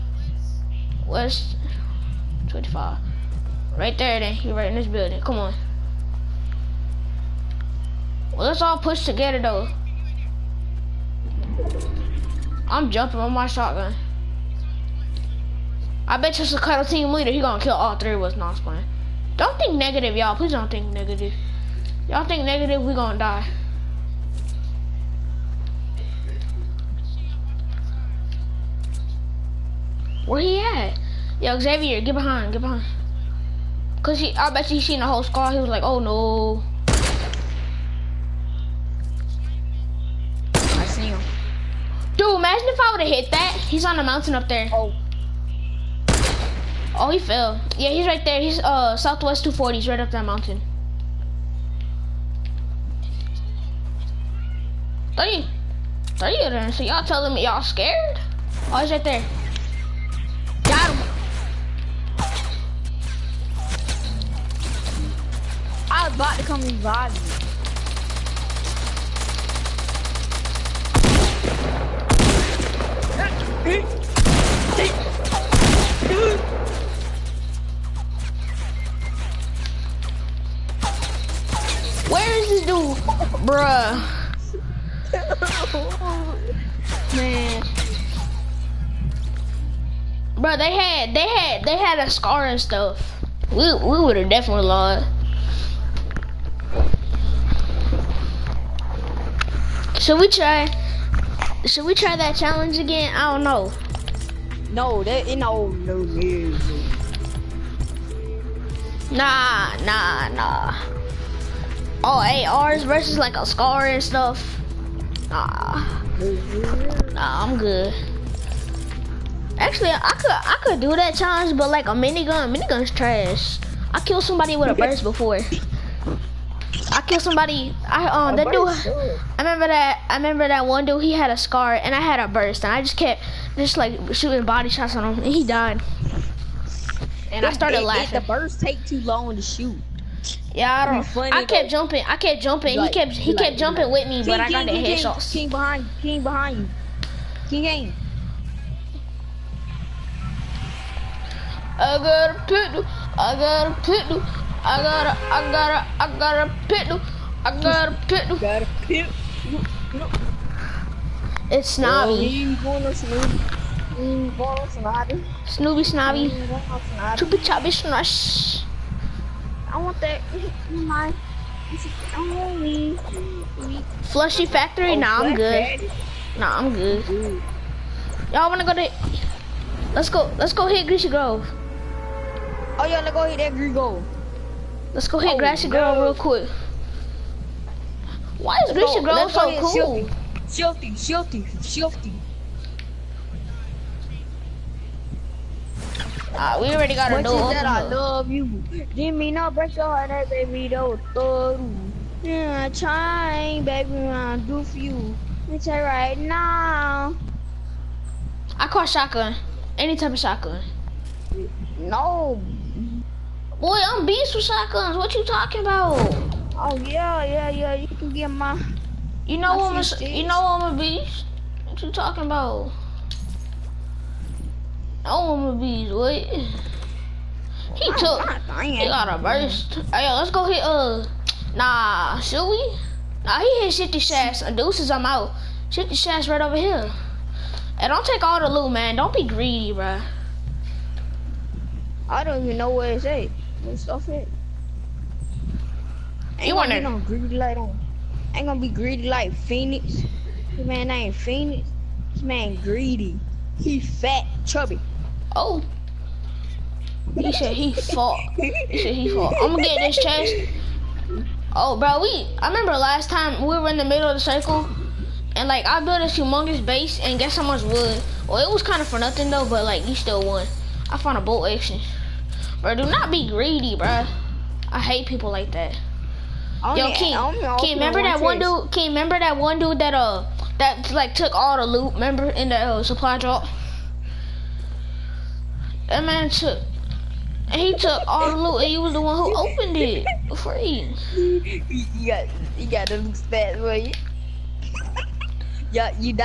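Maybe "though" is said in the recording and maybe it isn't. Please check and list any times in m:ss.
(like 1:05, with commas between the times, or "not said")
0:09, 4:29.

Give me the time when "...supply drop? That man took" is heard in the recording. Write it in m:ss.
4:42.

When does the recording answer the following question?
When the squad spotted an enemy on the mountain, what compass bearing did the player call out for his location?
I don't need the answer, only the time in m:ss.
0:48.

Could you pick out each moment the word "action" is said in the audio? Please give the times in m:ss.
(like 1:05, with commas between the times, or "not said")
4:31.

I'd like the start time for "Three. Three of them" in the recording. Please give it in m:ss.
0:55.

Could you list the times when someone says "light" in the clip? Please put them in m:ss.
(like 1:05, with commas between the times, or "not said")
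4:07.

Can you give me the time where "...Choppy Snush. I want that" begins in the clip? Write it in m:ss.
2:47.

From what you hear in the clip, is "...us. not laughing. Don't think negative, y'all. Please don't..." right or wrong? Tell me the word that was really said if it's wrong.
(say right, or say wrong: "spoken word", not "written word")
wrong: "playing", not "laughing".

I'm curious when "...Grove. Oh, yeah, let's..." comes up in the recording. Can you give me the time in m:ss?
3:01.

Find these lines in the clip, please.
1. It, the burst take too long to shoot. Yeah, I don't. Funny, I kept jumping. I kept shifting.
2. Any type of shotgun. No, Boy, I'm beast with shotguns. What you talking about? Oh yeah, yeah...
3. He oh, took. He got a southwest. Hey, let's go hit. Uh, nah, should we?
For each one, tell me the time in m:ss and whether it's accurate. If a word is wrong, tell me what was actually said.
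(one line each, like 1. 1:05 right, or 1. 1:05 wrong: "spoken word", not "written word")
1. 2:18 wrong: "jumping", not "shifting"
2. 3:29 right
3. 3:46 wrong: "burst", not "southwest".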